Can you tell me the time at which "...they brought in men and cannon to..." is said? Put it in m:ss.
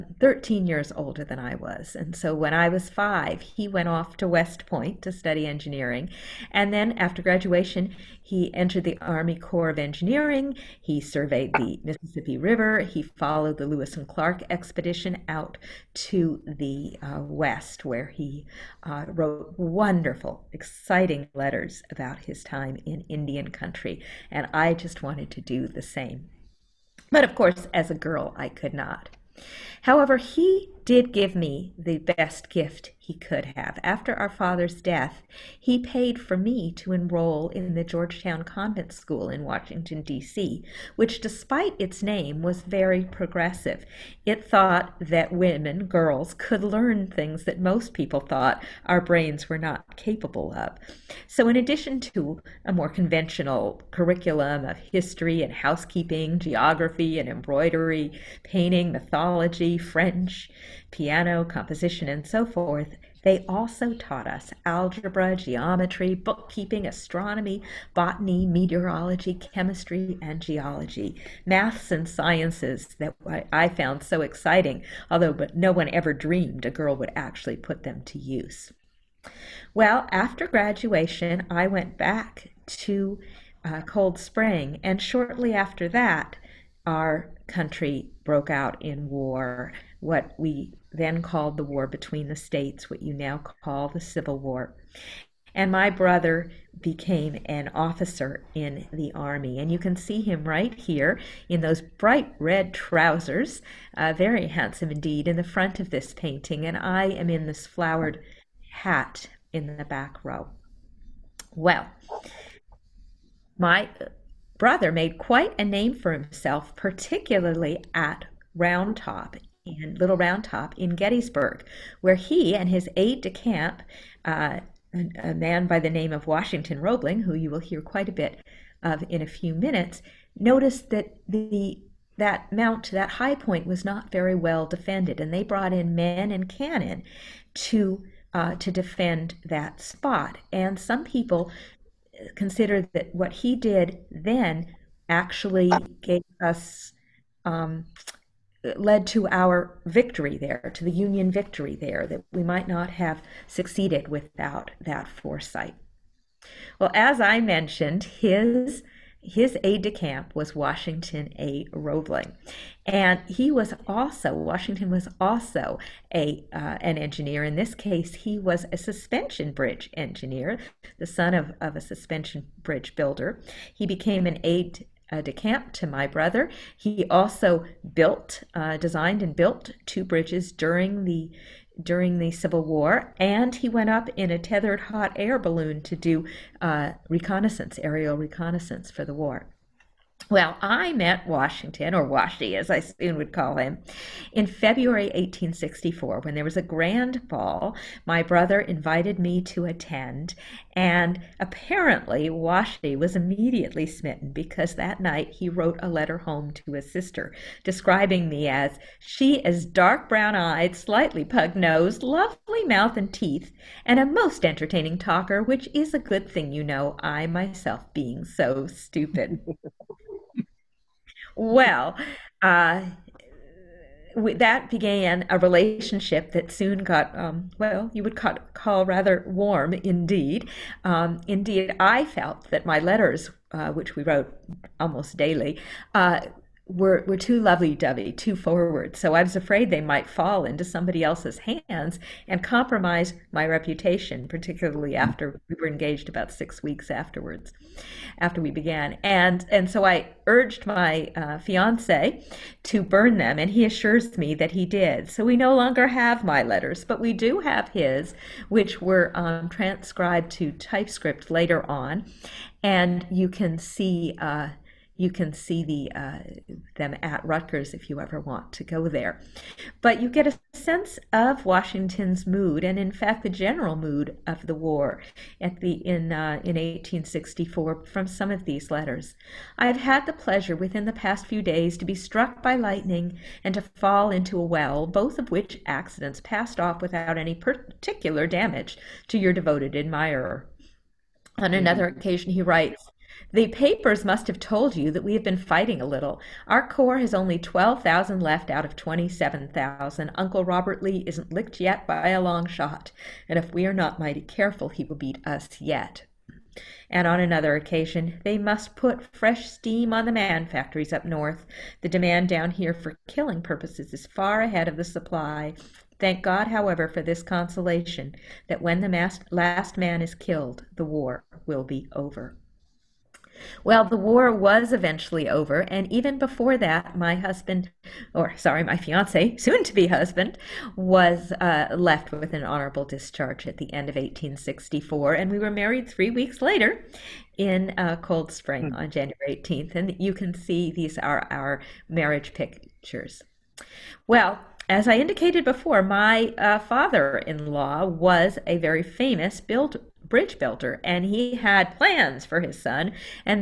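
2:15.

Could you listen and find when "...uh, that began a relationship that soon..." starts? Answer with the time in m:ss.
3:42.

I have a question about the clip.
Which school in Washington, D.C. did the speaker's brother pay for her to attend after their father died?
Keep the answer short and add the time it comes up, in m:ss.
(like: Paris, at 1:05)
Georgetown Convent School, at 0:37.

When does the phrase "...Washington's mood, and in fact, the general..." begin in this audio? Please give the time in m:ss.
4:31.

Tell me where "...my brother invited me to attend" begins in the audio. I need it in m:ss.
3:18.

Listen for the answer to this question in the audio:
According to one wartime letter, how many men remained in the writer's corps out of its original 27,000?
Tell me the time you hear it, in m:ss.
4:57.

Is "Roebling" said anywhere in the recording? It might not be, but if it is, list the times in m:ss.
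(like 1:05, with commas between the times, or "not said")
2:06, 2:41.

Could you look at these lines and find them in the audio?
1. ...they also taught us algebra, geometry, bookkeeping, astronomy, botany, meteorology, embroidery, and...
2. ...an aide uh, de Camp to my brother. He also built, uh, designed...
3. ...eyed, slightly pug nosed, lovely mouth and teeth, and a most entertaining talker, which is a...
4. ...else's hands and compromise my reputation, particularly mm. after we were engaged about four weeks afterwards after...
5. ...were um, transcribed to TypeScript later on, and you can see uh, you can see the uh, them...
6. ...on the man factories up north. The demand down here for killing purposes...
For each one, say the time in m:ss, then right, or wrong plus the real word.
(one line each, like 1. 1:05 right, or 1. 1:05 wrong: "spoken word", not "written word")
1. 1:03 wrong: "chemistry", not "embroidery"
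2. 2:54 right
3. 3:30 right
4. 4:01 wrong: "six", not "four"
5. 4:18 right
6. 5:09 right.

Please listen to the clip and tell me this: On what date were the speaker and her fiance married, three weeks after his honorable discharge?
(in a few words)
January 18th.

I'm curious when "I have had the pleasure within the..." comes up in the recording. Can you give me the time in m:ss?
4:39.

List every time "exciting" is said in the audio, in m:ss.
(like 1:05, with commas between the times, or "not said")
0:20, 1:14.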